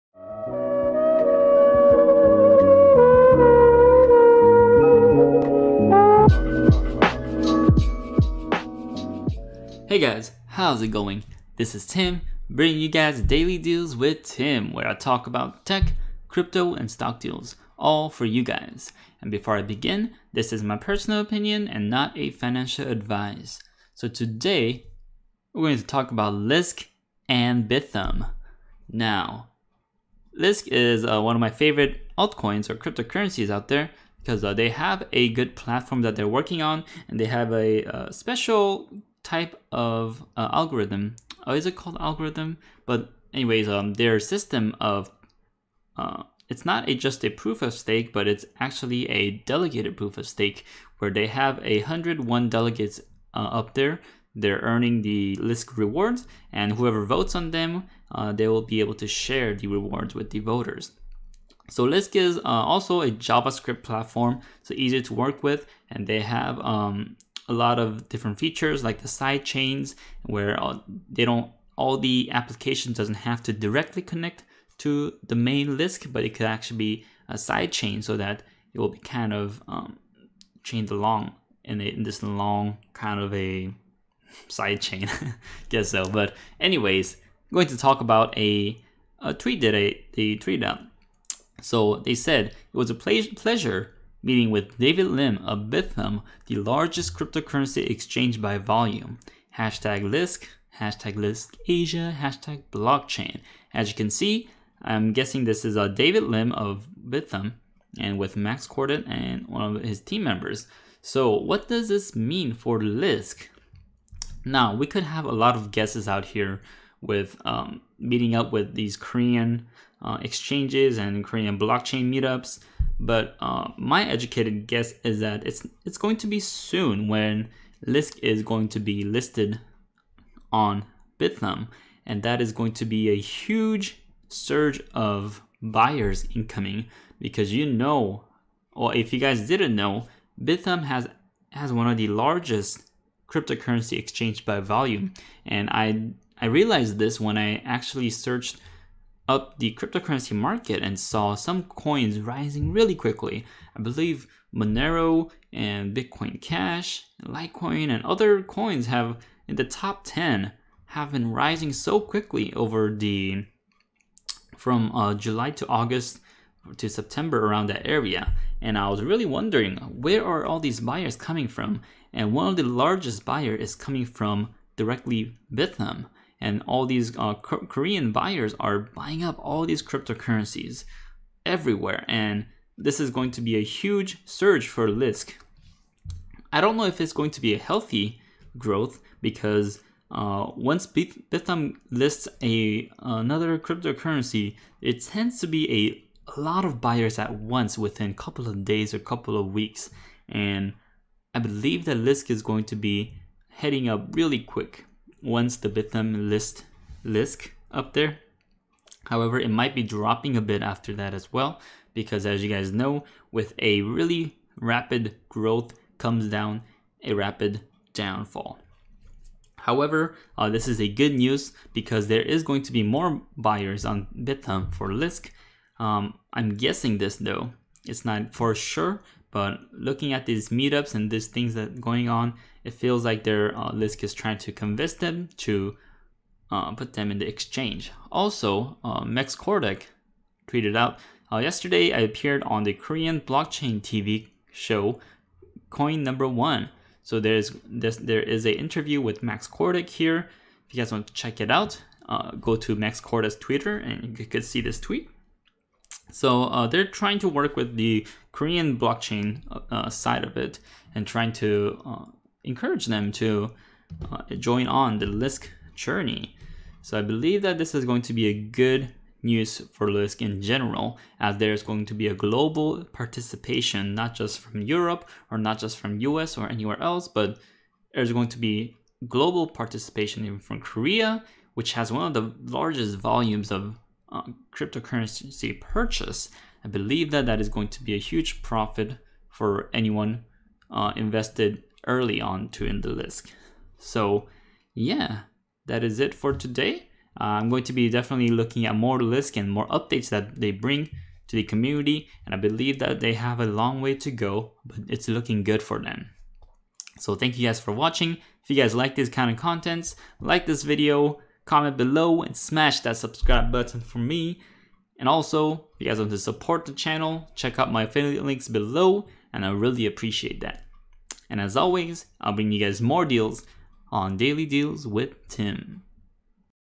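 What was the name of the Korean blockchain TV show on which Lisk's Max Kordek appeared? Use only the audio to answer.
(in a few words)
Coin Number One.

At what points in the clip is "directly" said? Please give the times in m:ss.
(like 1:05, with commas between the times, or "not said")
1:13, 2:54.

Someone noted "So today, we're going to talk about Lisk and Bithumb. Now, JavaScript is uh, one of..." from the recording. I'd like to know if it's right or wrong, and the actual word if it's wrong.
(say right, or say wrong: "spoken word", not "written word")
wrong: "Lisk", not "JavaScript".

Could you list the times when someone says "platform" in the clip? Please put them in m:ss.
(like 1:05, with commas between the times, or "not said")
0:35, 1:03.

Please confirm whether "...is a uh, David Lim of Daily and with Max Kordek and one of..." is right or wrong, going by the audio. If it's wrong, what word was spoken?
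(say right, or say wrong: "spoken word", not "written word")
wrong: "Bithumb", not "Daily".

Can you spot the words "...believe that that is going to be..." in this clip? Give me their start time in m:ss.
4:46.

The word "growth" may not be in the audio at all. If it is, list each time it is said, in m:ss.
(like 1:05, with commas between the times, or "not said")
3:08, 3:35.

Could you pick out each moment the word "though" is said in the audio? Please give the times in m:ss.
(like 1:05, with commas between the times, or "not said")
3:47.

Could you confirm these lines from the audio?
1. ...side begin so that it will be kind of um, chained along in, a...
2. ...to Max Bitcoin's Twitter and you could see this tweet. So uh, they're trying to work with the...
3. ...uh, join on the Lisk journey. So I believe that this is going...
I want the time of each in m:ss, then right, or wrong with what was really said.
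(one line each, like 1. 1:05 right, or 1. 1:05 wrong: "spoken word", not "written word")
1. 1:17 wrong: "chain", not "begin"
2. 4:12 wrong: "Kordek", not "Bitcoin"
3. 4:24 right.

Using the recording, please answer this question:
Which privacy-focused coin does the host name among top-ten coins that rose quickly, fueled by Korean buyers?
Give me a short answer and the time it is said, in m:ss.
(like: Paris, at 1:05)
Monero, at 2:34.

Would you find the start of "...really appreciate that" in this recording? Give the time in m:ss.
5:19.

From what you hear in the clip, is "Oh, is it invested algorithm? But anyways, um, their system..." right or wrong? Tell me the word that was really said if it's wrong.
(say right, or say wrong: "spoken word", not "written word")
wrong: "called", not "invested".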